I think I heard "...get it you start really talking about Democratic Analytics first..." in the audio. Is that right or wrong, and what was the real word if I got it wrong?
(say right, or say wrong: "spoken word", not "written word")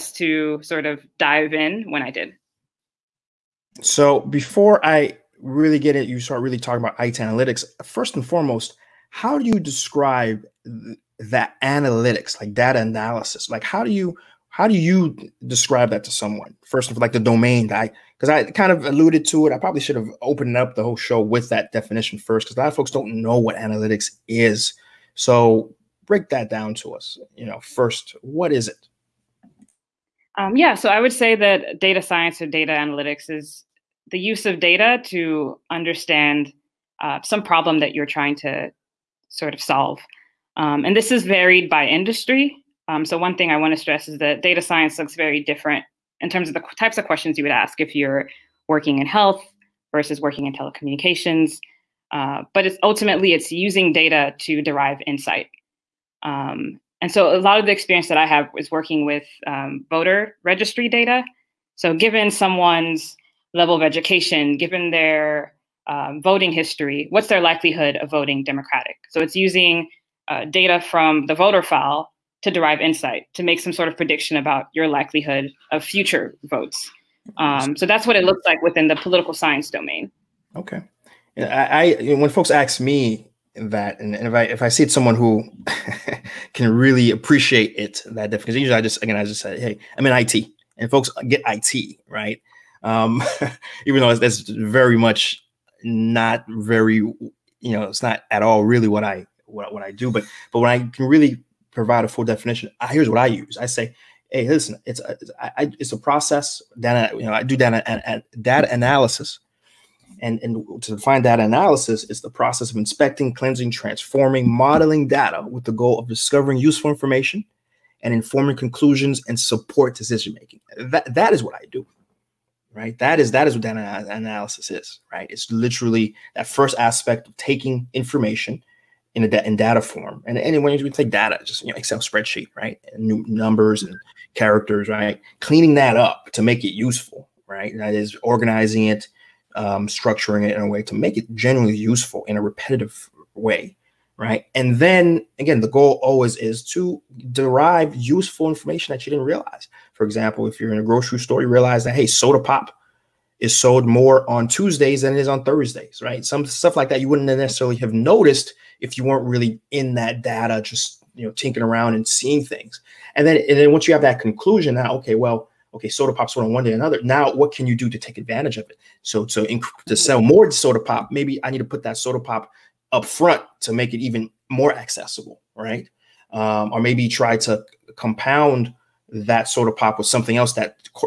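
wrong: "Ayiti", not "Democratic".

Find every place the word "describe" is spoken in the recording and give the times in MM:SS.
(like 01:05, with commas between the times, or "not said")
00:09, 00:15.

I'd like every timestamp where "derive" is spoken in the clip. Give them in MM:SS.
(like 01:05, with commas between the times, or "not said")
00:54, 01:12, 02:27.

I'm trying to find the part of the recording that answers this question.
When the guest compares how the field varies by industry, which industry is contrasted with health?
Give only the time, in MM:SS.
00:50.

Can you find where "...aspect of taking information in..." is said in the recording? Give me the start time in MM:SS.
02:06.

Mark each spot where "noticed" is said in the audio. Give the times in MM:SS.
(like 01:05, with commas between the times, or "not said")
02:37.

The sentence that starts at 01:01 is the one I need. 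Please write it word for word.
So given someone's level of education, given their um, voting history, what's their likelihood of voting Democratic?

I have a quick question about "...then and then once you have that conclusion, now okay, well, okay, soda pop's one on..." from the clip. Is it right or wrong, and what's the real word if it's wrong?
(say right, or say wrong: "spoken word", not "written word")
right.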